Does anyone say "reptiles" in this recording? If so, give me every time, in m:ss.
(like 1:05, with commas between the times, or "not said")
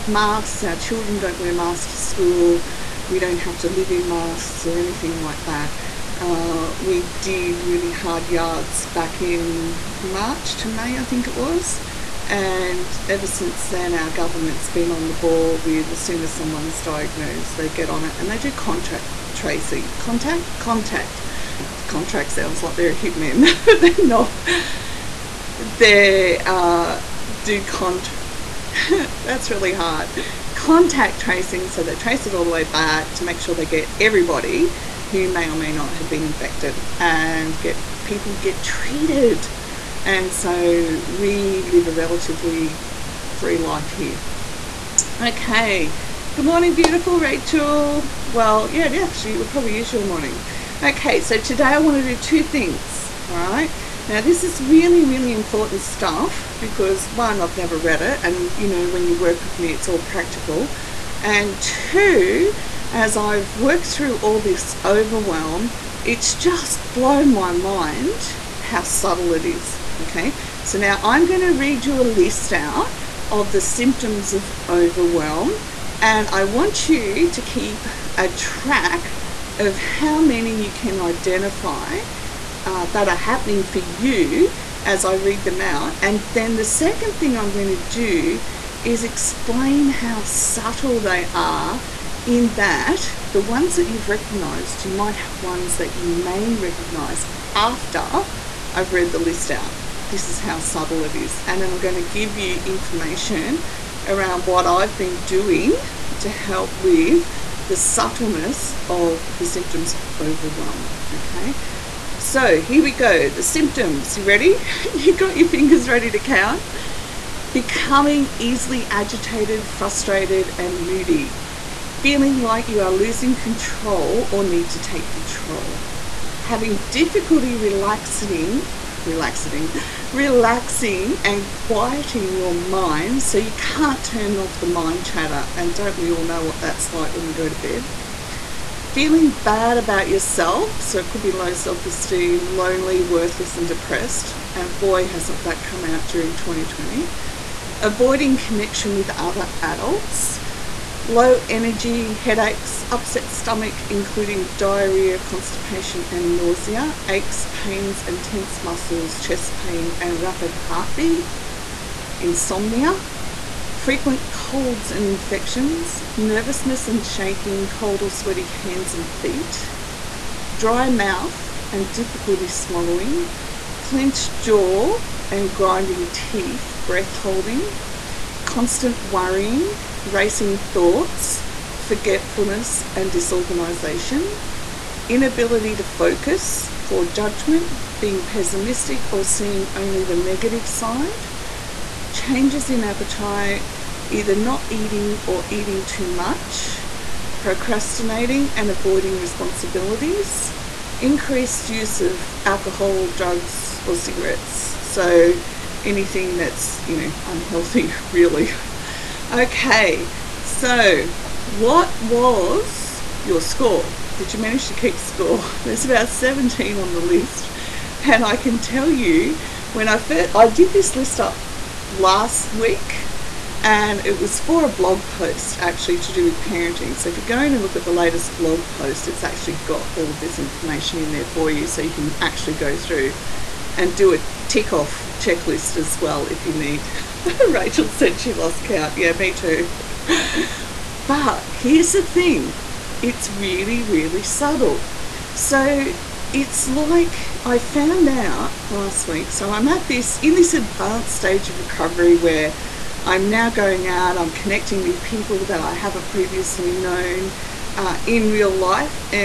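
not said.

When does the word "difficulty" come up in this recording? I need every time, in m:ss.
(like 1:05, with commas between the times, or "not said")
2:06, 2:51.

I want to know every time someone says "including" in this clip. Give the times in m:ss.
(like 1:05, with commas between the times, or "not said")
2:33.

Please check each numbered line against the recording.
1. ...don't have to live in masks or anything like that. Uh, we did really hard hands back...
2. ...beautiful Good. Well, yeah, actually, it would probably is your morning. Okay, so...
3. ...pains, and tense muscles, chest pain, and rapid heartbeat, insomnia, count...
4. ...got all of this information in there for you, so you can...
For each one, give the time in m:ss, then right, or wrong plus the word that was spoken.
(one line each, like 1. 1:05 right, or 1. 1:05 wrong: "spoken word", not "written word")
1. 0:03 wrong: "yards", not "hands"
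2. 0:46 wrong: "Rachel", not "Good"
3. 2:37 wrong: "frequent", not "count"
4. 3:49 right.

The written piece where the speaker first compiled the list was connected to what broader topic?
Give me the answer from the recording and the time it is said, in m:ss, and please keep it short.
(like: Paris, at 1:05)
Parenting, at 3:46.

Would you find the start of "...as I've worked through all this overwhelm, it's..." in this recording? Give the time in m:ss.
1:02.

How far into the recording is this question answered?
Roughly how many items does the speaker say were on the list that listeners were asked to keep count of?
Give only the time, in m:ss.
3:36.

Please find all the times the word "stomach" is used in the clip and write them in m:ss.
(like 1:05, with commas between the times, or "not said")
2:33.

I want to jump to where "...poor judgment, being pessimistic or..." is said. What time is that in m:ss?
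3:06.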